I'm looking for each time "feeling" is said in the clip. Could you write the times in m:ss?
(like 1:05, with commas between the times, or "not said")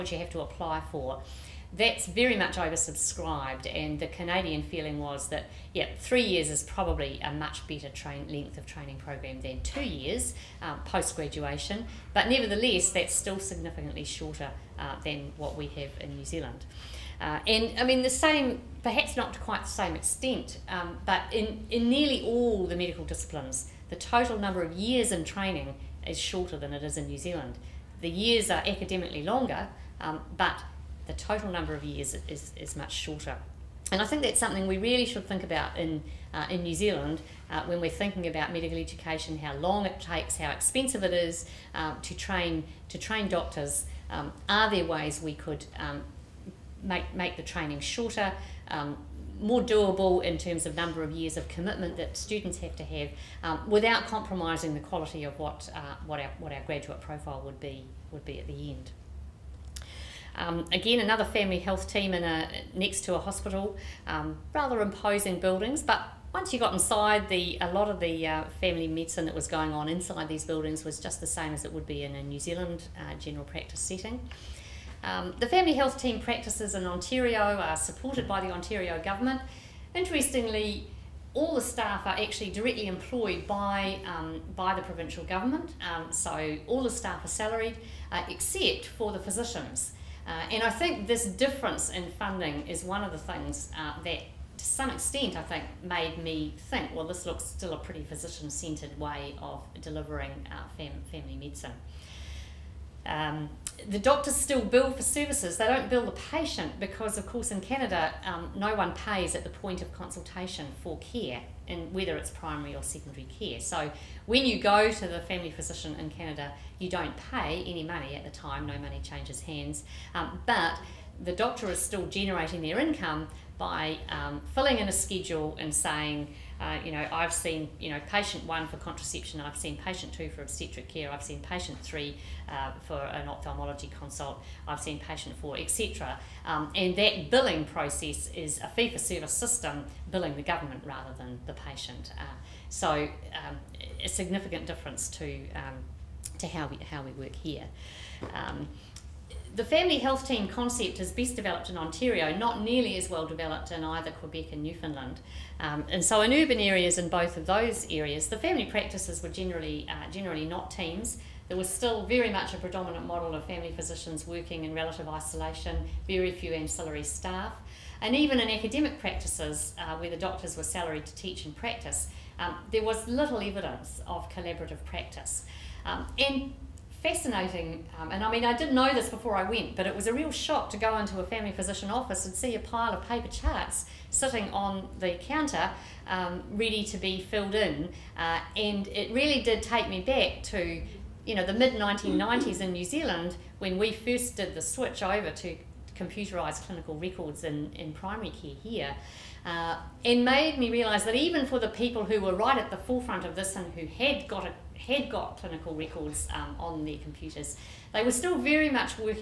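0:04.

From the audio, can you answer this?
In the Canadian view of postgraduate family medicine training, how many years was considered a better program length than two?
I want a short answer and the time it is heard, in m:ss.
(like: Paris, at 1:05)
3 years, at 0:05.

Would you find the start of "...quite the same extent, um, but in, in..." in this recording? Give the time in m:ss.
0:19.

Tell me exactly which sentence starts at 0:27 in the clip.
The years are academically longer, um, but the total number of years is, is much shorter.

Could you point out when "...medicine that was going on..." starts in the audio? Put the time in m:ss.
1:08.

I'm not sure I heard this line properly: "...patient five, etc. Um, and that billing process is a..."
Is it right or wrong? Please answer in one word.
wrong.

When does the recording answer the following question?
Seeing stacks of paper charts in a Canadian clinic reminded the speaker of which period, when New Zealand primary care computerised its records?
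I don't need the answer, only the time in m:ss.
3:11.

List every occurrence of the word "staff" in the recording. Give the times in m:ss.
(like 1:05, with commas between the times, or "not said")
1:21, 1:26, 2:47.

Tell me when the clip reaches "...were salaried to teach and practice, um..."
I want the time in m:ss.
2:50.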